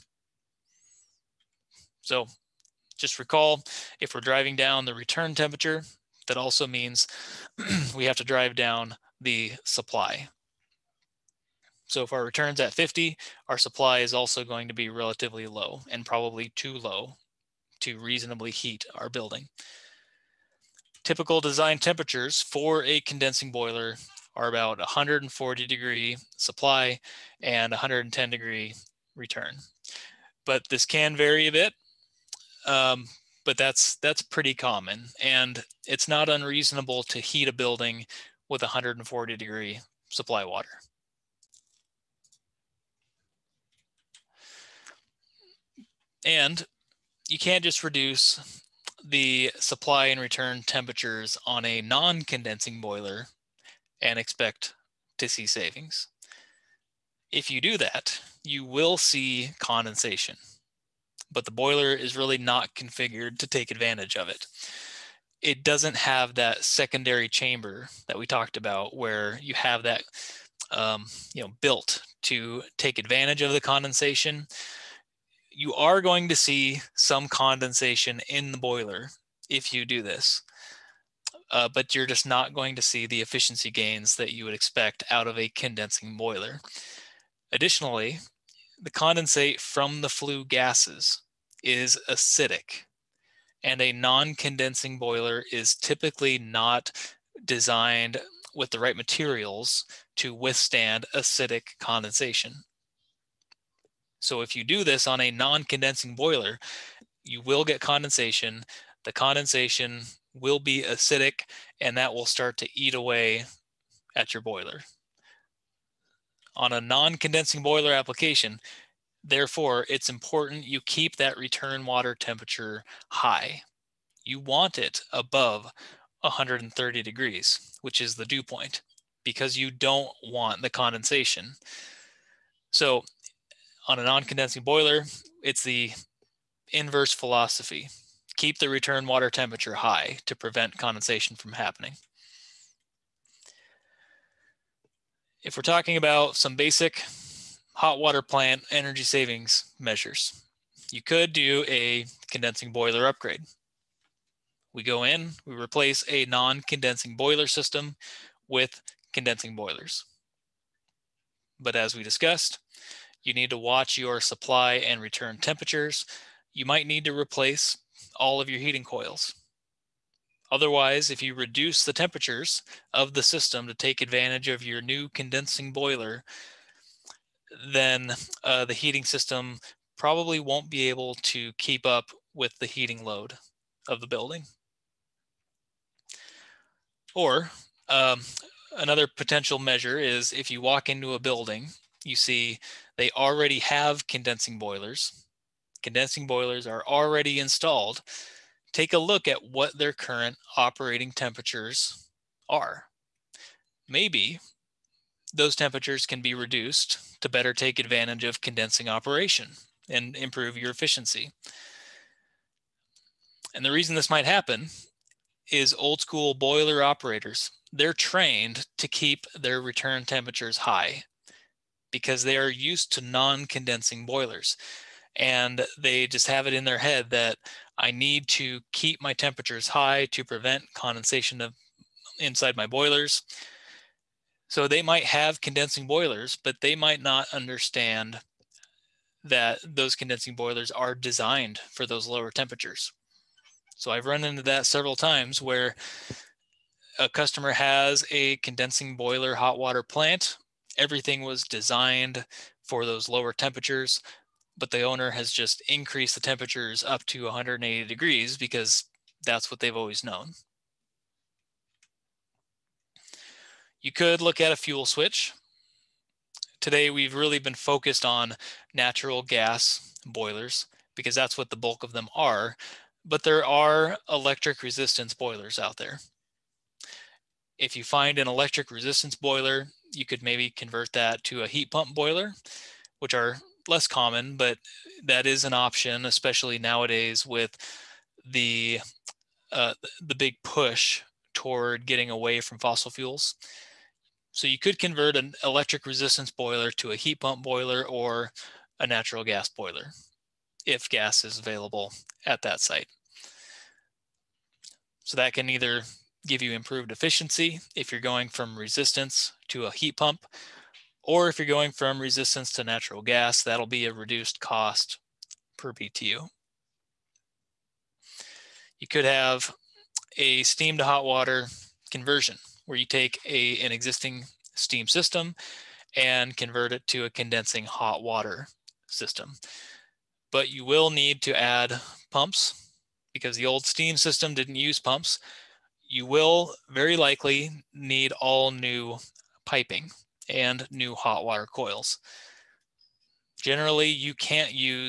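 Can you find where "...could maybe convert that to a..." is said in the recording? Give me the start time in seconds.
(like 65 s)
280 s.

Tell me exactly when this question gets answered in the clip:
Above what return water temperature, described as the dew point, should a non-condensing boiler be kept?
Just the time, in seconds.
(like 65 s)
126 s.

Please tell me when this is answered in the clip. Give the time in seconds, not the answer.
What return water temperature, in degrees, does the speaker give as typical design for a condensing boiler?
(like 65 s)
27 s.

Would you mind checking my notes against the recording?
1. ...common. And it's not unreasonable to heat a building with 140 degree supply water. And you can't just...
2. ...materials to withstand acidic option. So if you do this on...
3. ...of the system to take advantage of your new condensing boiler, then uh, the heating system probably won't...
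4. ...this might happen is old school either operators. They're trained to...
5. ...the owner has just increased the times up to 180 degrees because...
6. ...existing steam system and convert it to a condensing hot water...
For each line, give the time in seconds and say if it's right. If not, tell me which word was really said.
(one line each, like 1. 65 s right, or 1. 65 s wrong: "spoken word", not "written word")
1. 34 s right
2. 98 s wrong: "condensation", not "option"
3. 172 s right
4. 213 s wrong: "boiler", not "either"
5. 254 s wrong: "temperatures", not "times"
6. 323 s right.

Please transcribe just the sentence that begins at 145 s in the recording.
If we're talking about some basic hot water plant energy savings measures, you could do a condensing boiler upgrade.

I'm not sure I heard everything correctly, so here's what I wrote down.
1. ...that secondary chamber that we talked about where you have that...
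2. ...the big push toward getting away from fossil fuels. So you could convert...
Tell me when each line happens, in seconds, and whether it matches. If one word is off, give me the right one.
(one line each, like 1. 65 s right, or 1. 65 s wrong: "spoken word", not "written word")
1. 66 s right
2. 289 s right.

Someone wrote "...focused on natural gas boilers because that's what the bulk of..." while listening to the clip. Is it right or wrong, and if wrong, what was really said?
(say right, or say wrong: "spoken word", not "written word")
right.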